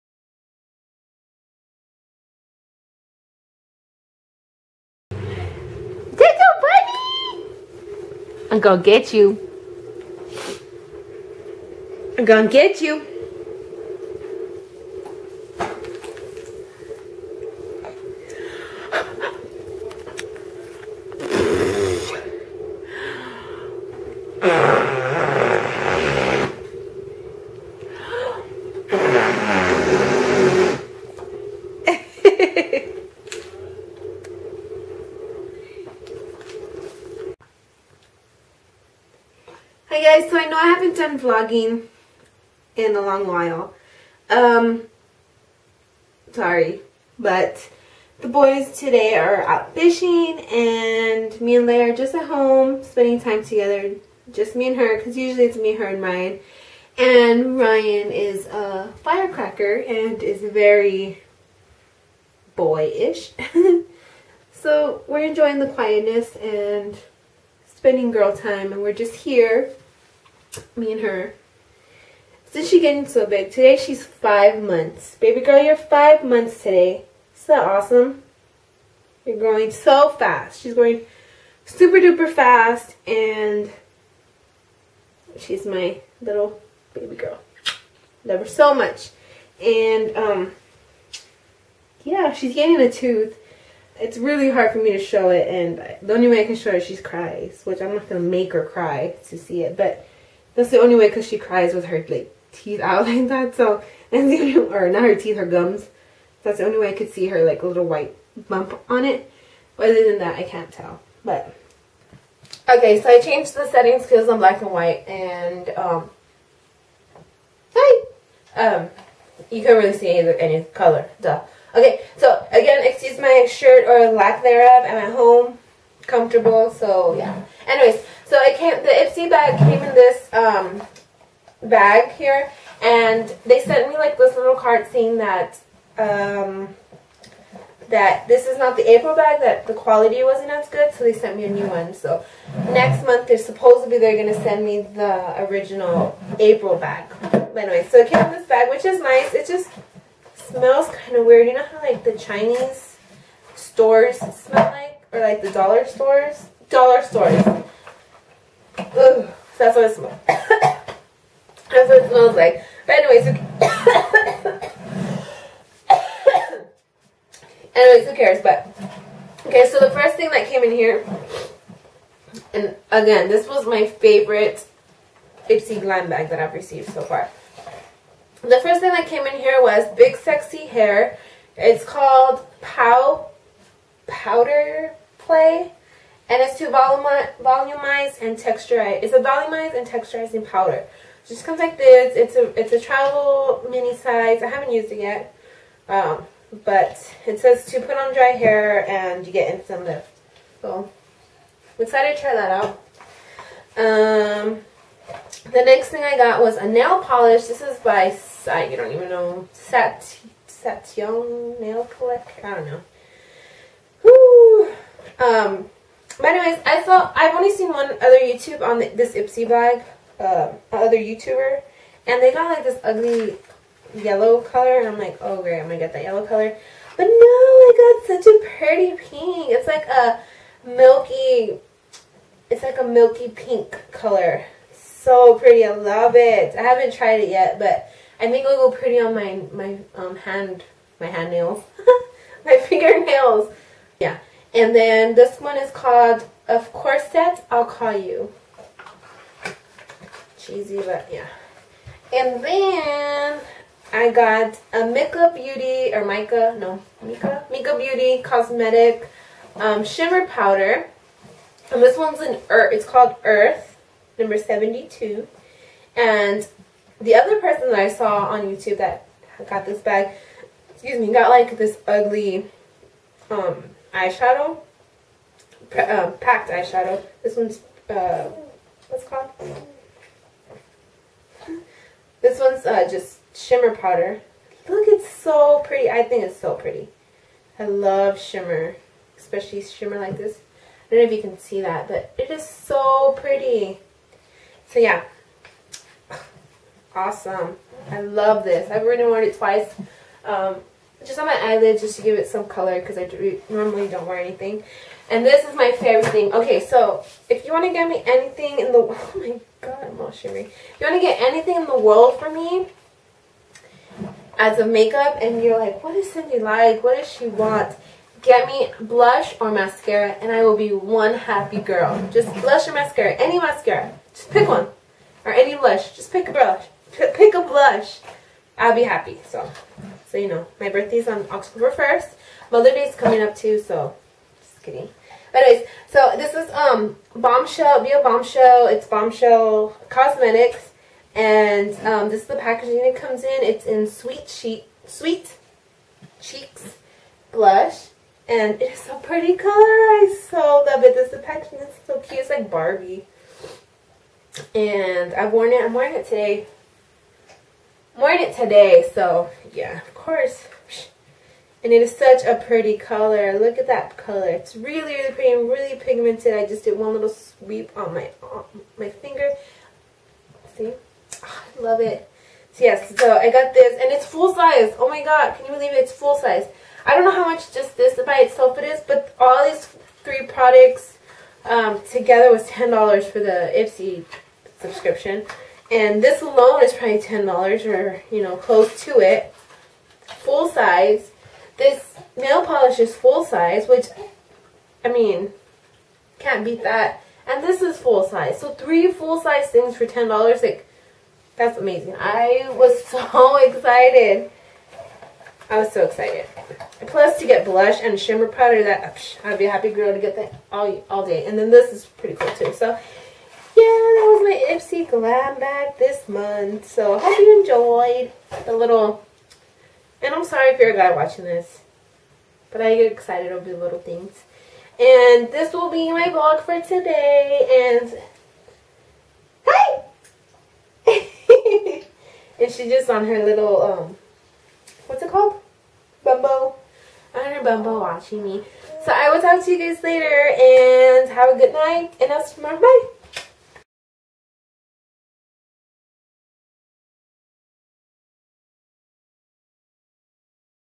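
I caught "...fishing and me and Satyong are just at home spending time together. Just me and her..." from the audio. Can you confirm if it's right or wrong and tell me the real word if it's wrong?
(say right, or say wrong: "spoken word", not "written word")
wrong: "Leia", not "Satyong".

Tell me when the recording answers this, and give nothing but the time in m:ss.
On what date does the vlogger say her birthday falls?
5:31.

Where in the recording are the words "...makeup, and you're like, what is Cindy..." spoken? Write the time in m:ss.
5:14.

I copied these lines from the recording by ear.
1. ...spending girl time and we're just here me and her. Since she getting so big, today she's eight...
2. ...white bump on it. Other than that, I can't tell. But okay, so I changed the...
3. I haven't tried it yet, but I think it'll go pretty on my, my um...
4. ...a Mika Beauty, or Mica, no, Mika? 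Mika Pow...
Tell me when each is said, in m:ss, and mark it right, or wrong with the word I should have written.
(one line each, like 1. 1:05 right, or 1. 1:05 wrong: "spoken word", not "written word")
1. 1:07 wrong: "five", not "eight"
2. 1:47 right
3. 3:56 right
4. 4:14 wrong: "Beauty", not "Pow".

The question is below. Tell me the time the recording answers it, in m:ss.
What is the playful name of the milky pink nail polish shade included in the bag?
4:06.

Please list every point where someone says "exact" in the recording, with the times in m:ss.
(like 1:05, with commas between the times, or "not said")
not said.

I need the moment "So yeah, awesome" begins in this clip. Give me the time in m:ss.
4:54.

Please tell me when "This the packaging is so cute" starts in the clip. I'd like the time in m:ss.
5:50.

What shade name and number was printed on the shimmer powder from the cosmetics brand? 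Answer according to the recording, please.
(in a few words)
Earth, number 72.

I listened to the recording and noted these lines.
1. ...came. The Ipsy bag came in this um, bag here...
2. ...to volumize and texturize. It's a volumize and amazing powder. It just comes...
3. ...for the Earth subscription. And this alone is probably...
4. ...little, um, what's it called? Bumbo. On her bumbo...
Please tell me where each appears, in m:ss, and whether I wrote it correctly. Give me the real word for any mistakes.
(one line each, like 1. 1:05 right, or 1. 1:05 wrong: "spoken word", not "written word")
1. 2:08 right
2. 3:06 wrong: "texturizing", not "amazing"
3. 6:23 wrong: "Ipsy", not "Earth"
4. 7:13 right.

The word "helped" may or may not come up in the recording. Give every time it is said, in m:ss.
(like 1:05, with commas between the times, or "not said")
not said.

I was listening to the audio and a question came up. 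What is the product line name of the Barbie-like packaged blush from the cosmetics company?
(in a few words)
Sweet Cheeks.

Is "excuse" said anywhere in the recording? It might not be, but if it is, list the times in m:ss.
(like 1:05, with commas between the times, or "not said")
2:02, 4:30.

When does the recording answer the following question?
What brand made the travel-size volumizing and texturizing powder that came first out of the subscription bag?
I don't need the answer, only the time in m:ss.
2:59.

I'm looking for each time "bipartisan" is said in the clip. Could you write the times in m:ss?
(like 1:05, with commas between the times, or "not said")
not said.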